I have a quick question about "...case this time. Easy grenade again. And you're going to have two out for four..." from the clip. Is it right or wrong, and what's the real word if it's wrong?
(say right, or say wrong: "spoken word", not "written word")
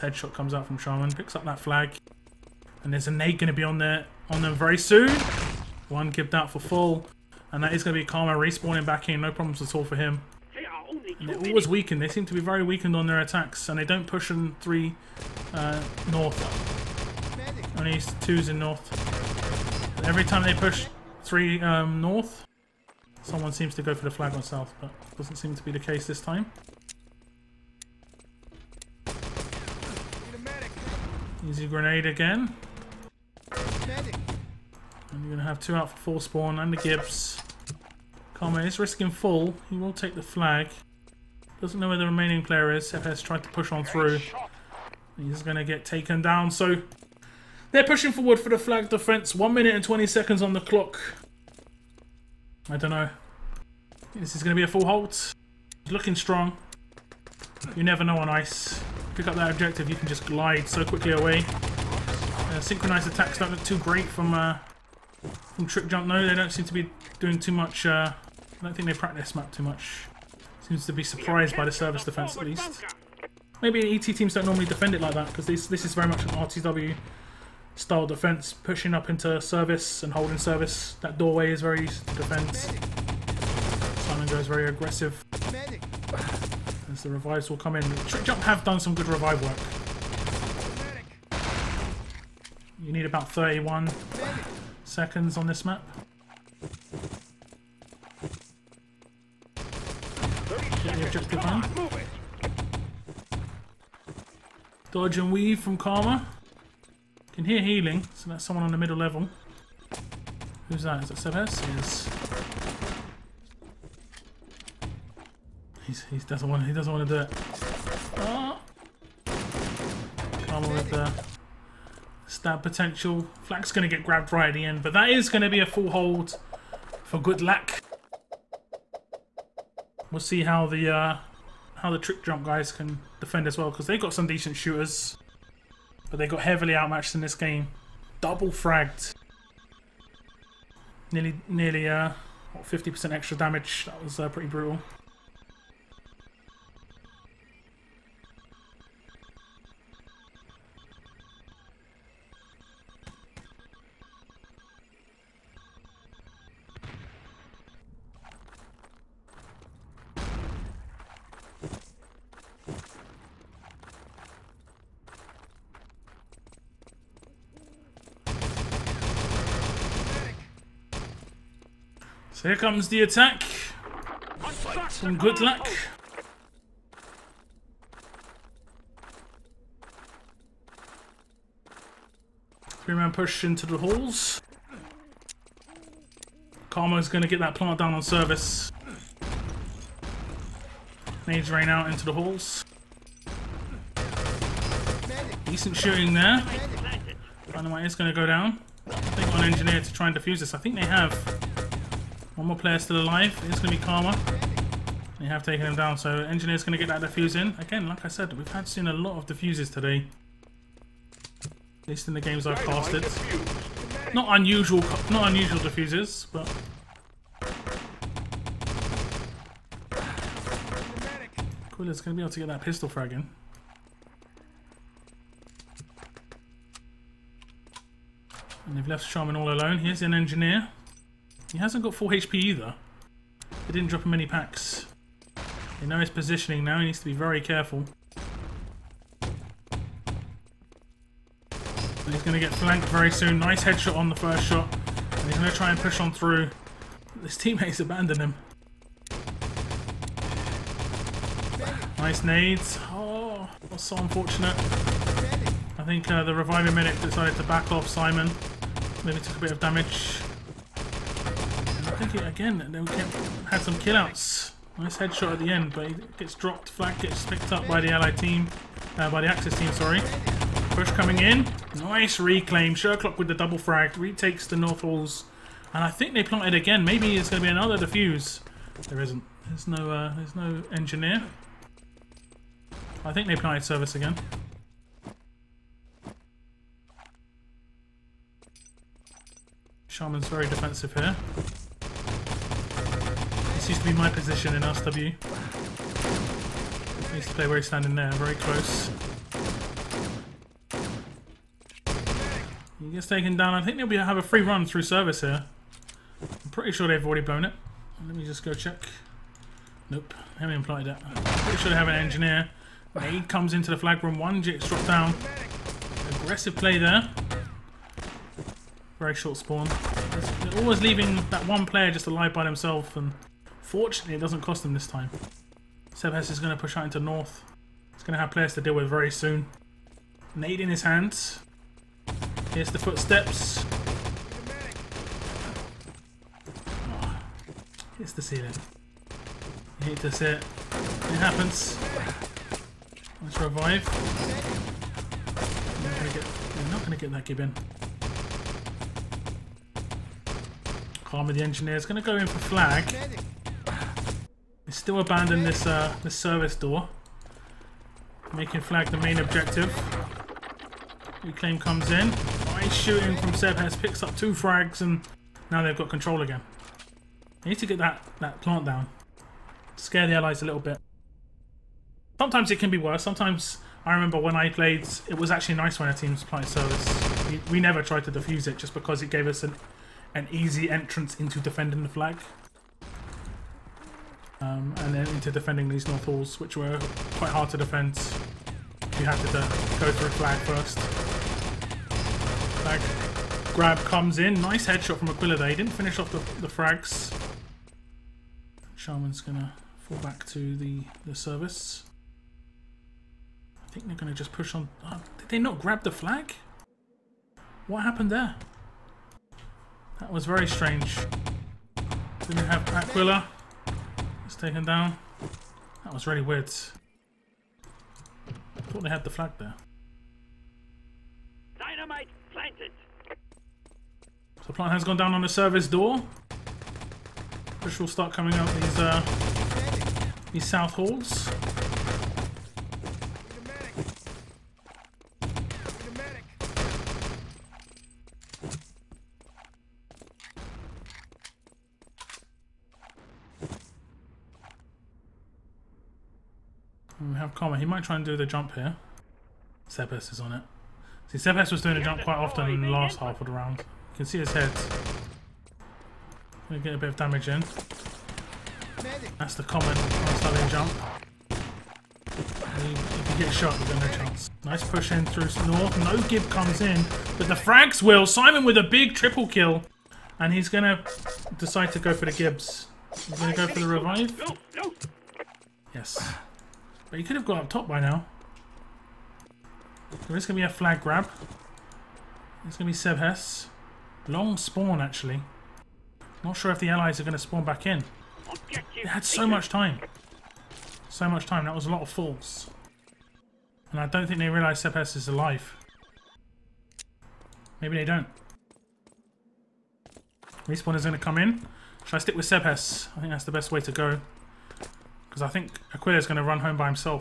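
right.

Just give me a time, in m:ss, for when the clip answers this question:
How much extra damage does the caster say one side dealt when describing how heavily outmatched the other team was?
2:22.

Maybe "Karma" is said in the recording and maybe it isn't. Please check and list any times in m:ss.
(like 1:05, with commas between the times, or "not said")
0:08, 0:38, 1:45, 3:06, 3:23, 5:51, 7:27.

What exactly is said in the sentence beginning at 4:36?
Maybe it's going to be another defuse.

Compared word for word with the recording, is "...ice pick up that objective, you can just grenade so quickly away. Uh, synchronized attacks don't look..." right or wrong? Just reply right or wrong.
wrong.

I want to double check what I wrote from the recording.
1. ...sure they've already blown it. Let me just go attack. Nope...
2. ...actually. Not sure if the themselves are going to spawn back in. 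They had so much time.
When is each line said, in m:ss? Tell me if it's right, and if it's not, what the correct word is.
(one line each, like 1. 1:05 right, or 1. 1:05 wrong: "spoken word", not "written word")
1. 5:06 wrong: "check", not "attack"
2. 8:04 wrong: "allies", not "themselves".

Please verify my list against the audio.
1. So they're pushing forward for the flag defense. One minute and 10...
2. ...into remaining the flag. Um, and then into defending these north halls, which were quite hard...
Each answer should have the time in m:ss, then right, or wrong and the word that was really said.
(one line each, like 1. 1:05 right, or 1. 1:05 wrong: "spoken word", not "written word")
1. 0:46 wrong: "20", not "10"
2. 6:21 wrong: "defending", not "remaining".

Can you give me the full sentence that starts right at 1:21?
That doorway is very easy to defend.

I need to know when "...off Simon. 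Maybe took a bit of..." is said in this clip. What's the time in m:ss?
4:17.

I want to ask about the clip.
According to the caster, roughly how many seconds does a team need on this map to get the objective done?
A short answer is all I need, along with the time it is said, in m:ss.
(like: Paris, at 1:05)
31 seconds, at 1:33.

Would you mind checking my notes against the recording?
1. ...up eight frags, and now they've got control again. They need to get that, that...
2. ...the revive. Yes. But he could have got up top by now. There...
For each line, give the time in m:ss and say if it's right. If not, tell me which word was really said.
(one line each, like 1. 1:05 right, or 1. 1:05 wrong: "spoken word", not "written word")
1. 6:04 wrong: "two", not "eight"
2. 7:53 right.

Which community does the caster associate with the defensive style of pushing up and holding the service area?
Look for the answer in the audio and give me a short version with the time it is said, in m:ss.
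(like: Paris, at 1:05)
RTW, at 1:16.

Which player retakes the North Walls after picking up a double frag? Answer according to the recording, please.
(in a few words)
Sherlock.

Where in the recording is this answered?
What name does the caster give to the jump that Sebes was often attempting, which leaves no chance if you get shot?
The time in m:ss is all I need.
7:39.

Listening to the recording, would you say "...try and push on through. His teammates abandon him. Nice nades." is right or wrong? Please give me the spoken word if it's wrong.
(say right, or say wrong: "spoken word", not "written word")
right.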